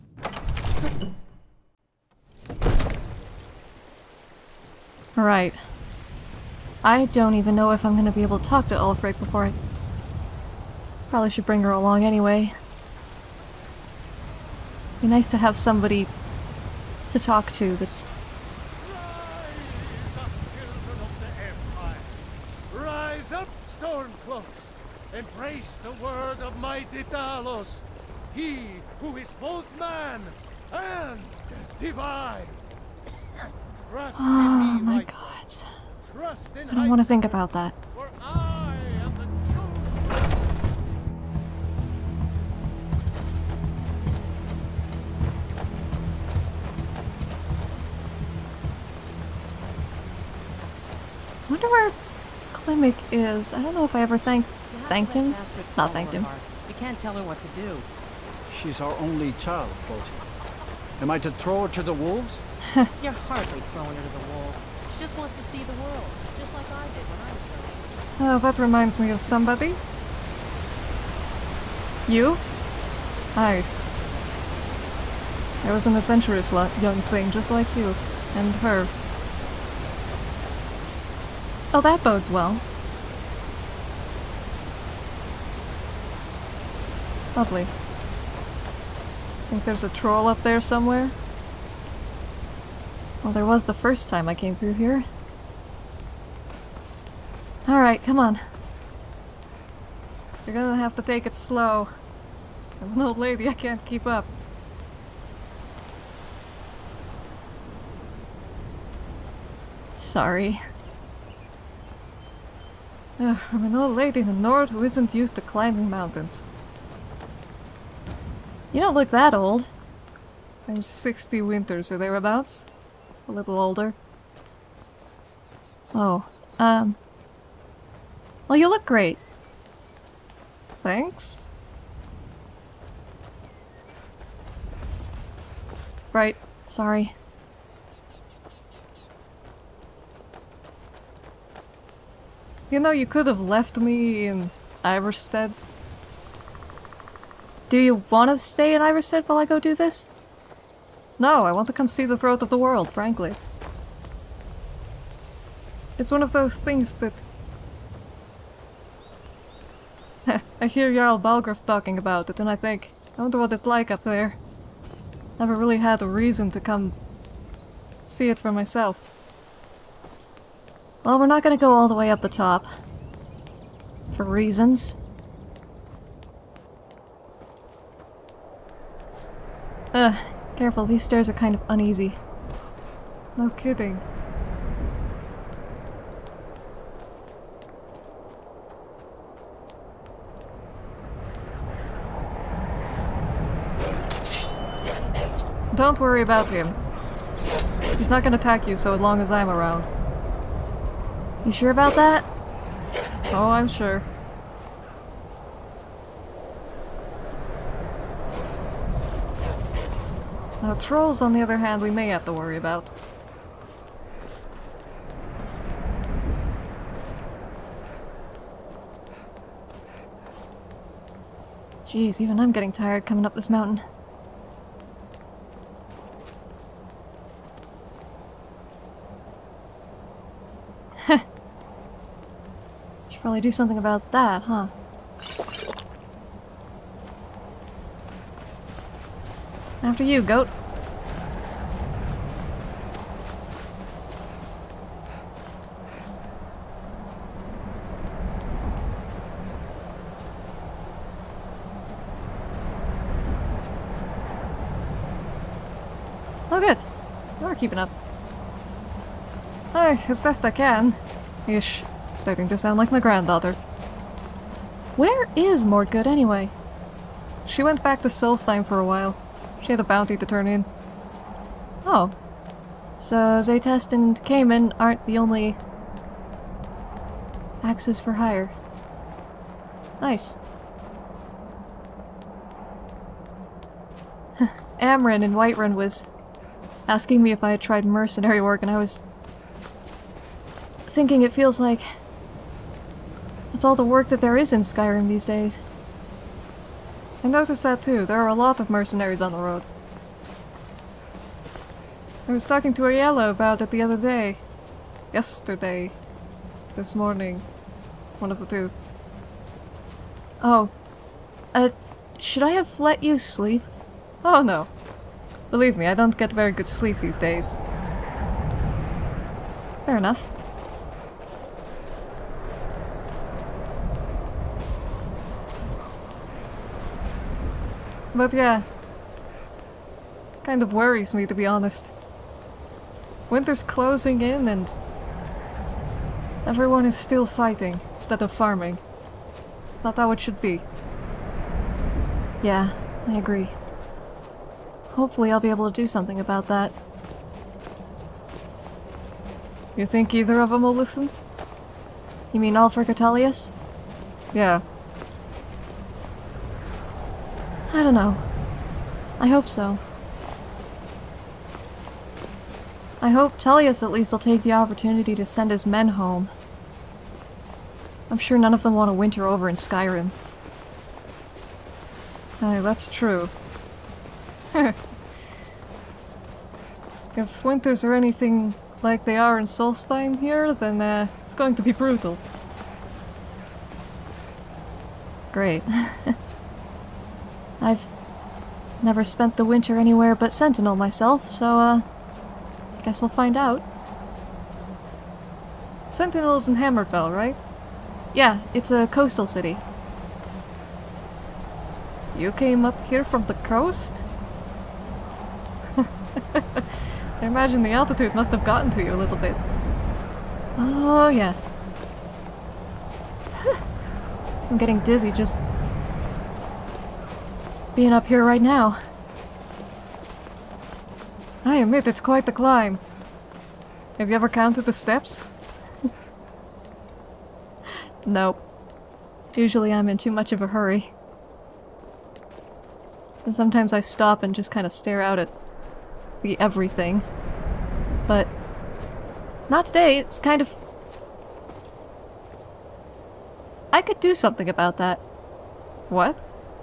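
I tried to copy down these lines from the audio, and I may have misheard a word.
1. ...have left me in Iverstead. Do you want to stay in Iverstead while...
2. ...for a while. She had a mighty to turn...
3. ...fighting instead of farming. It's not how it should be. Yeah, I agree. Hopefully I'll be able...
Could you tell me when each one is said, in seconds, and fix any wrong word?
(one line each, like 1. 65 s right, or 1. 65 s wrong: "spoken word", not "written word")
1. 143 s right
2. 268 s wrong: "bounty", not "mighty"
3. 337 s right.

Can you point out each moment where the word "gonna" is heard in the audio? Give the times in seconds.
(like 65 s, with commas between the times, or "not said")
7 s, 100 s, 198 s.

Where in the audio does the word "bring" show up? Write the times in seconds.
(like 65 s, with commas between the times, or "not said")
11 s.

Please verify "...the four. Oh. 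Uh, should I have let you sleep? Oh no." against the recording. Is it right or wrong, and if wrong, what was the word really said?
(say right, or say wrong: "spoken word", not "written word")
wrong: "two", not "four".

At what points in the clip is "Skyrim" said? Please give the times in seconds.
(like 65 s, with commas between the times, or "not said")
294 s, 369 s.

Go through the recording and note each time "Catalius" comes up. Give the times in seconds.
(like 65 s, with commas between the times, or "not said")
352 s.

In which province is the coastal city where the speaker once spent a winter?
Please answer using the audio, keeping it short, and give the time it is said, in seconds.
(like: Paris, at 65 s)
Hammerfell, at 396 s.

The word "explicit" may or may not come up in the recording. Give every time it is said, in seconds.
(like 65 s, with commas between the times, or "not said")
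not said.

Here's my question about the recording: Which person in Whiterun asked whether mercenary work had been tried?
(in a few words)
Amren.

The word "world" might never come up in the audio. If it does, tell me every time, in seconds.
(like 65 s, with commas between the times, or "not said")
65 s, 152 s.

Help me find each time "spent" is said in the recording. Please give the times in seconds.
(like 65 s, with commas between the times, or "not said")
389 s.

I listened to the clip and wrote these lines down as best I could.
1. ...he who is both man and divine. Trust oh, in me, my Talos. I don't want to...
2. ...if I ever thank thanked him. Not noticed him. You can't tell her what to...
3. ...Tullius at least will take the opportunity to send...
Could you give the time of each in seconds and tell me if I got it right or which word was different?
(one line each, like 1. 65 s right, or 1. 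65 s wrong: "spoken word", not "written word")
1. 28 s wrong: "God", not "Talos"
2. 53 s wrong: "thanked", not "noticed"
3. 363 s right.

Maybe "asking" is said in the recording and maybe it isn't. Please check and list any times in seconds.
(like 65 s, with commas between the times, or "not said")
286 s.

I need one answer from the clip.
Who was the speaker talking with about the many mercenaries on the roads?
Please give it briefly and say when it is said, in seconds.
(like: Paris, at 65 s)
Ayala, at 302 s.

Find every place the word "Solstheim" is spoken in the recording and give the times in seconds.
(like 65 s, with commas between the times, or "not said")
268 s, 379 s.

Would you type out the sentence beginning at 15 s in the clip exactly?
Be nice to have somebody to talk to that's Rise up, stormcloaks!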